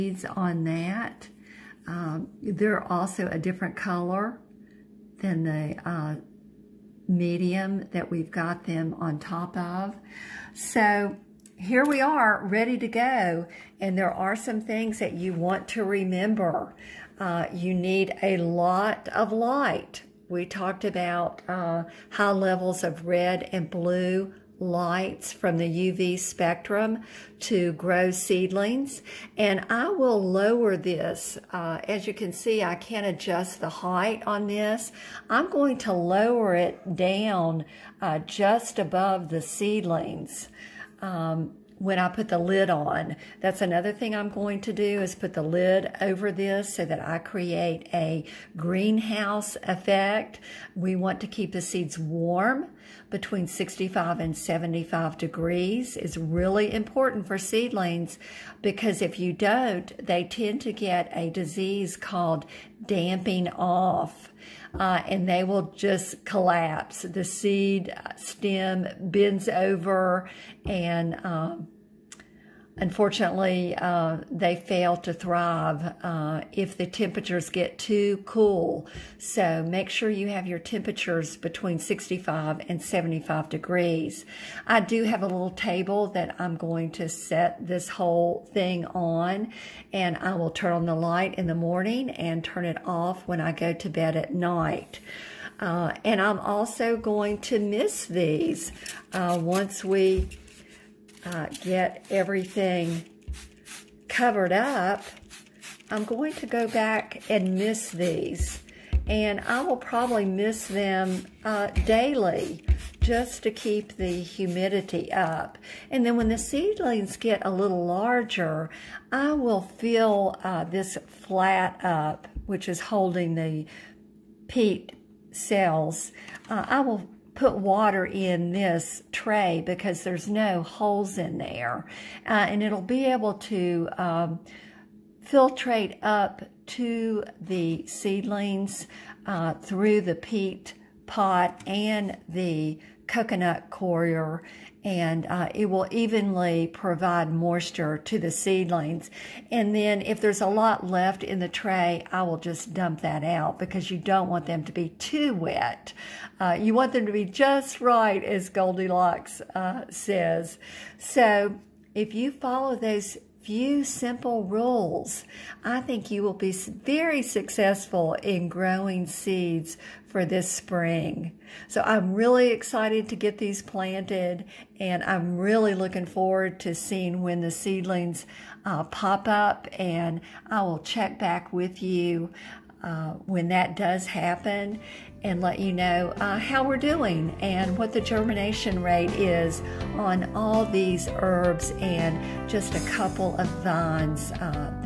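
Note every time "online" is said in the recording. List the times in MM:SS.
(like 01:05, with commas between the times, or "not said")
not said.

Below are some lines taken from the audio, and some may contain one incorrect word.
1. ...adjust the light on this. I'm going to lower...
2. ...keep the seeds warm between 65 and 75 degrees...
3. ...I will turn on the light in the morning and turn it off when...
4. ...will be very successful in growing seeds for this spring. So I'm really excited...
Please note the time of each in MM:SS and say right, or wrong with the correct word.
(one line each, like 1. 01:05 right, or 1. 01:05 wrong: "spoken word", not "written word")
1. 00:33 wrong: "height", not "light"
2. 00:51 right
3. 01:30 right
4. 02:46 right.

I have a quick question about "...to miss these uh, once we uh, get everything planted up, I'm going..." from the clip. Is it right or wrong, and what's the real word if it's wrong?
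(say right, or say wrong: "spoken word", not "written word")
wrong: "covered", not "planted".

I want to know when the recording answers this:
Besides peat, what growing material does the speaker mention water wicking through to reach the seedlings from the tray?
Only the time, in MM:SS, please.
02:23.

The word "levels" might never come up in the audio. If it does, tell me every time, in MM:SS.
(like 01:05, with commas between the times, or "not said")
00:22.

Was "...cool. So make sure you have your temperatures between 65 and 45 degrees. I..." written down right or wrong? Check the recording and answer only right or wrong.
wrong.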